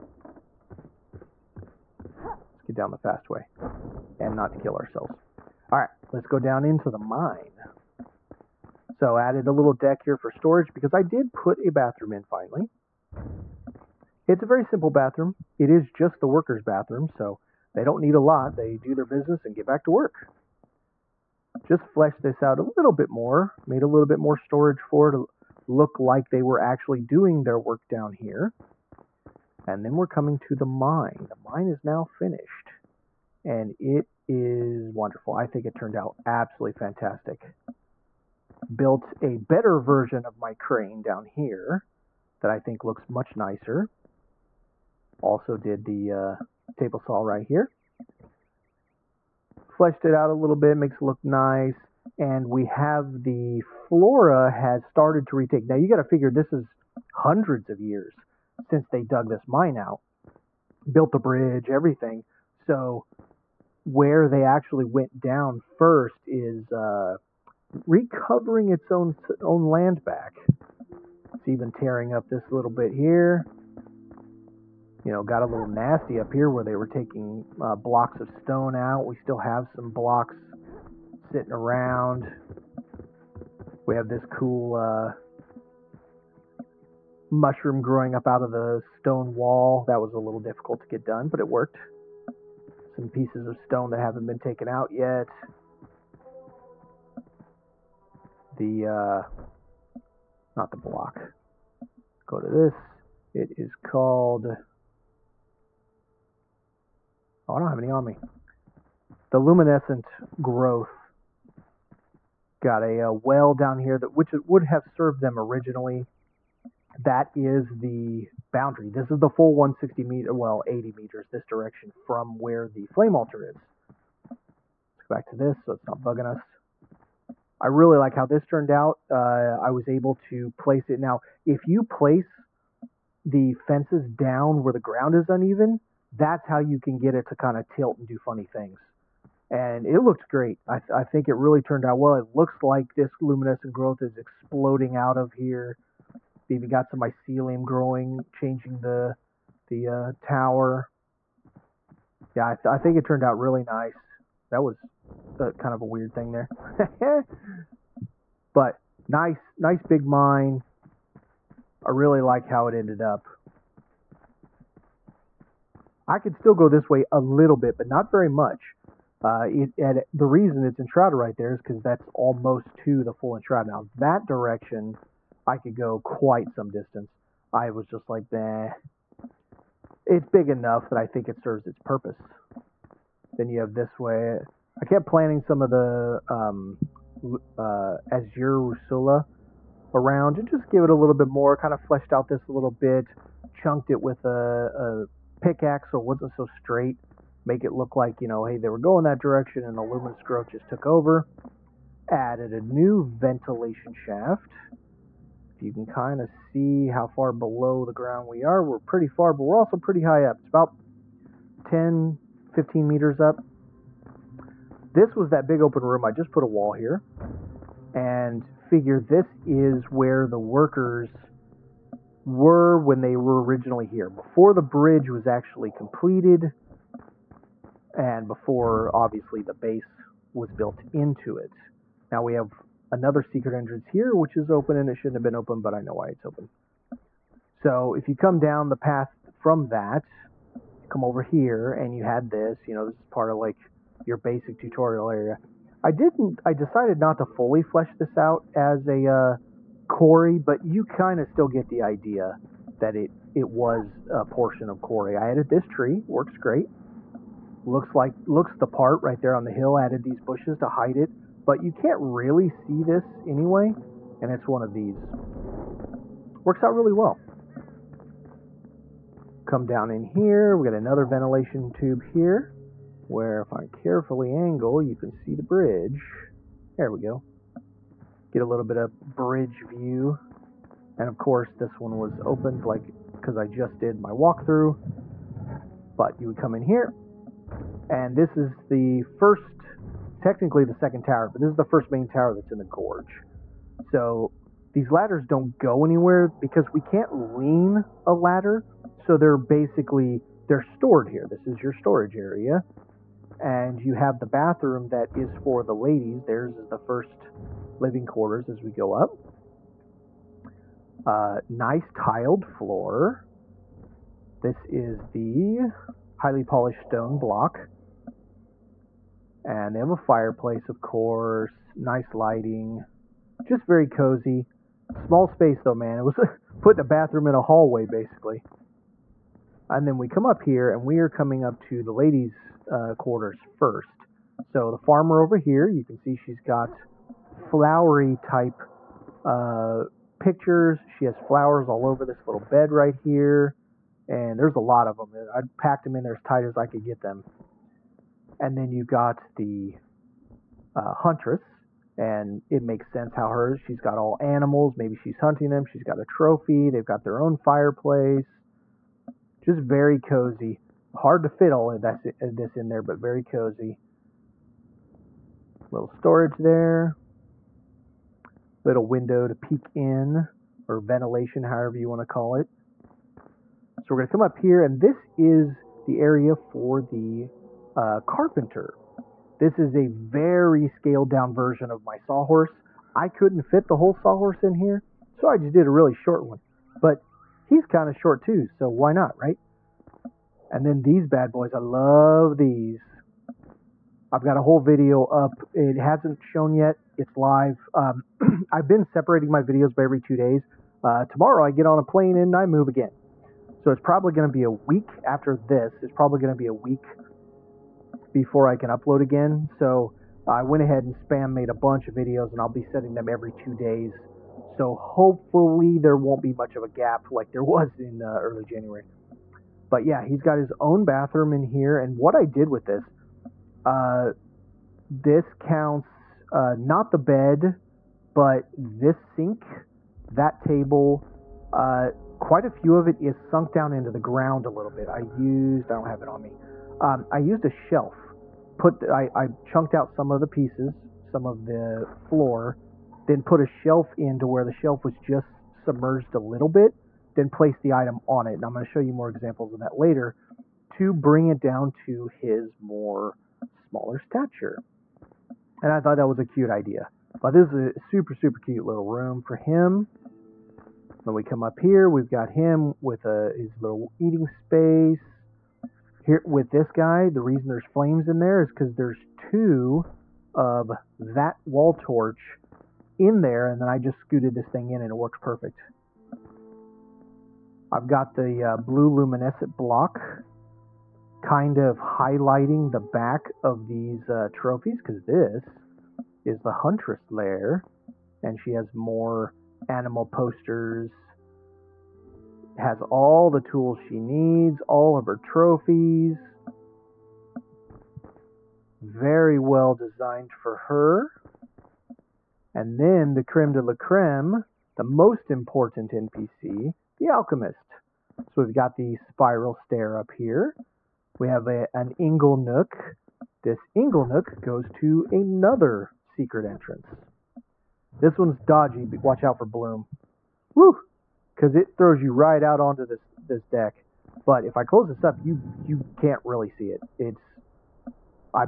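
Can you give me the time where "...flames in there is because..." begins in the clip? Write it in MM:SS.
07:47.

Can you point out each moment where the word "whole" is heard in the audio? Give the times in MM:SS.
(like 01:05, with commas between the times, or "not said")
06:23, 06:34.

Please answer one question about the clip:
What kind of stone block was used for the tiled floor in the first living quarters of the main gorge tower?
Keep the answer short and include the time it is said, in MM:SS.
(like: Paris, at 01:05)
highly polished stone block, at 05:16.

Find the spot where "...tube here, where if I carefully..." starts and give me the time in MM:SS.
04:31.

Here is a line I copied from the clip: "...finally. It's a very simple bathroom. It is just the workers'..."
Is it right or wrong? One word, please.
right.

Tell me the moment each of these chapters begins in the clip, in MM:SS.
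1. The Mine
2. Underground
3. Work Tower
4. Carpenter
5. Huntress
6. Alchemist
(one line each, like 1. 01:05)
1. 00:29
2. 03:02
3. 04:47
4. 06:12
5. 07:56
6. 08:21.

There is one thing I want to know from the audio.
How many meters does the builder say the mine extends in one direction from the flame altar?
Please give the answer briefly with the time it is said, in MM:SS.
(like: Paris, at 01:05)
80 meters, at 02:00.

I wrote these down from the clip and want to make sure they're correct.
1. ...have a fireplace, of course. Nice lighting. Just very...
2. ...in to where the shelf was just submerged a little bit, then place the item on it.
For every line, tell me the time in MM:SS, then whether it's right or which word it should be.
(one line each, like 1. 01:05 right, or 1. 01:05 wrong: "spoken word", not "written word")
1. 05:19 right
2. 07:23 right.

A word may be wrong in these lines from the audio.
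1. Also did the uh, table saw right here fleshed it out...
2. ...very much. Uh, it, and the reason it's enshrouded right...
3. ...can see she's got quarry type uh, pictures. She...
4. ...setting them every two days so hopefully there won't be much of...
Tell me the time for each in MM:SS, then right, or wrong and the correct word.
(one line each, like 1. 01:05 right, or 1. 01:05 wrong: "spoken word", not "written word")
1. 00:45 right
2. 02:48 right
3. 05:35 wrong: "flowery", not "quarry"
4. 06:52 right.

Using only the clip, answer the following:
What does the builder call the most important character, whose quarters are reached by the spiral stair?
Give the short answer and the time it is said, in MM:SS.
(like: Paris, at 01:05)
the alchemist, at 08:27.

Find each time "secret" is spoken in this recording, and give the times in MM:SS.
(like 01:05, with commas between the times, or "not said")
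03:53, 08:36.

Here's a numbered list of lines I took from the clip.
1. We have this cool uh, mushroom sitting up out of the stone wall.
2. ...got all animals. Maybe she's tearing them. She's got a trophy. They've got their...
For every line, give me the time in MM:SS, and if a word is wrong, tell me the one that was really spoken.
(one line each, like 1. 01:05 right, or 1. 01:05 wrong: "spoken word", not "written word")
1. 01:23 wrong: "growing", not "sitting"
2. 05:53 wrong: "hunting", not "tearing".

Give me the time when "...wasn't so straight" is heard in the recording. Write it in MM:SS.
03:16.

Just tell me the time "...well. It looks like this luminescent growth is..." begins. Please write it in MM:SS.
02:21.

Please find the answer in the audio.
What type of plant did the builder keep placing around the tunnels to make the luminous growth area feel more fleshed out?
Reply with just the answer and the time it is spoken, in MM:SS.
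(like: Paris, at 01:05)
Azure Russula, at 03:08.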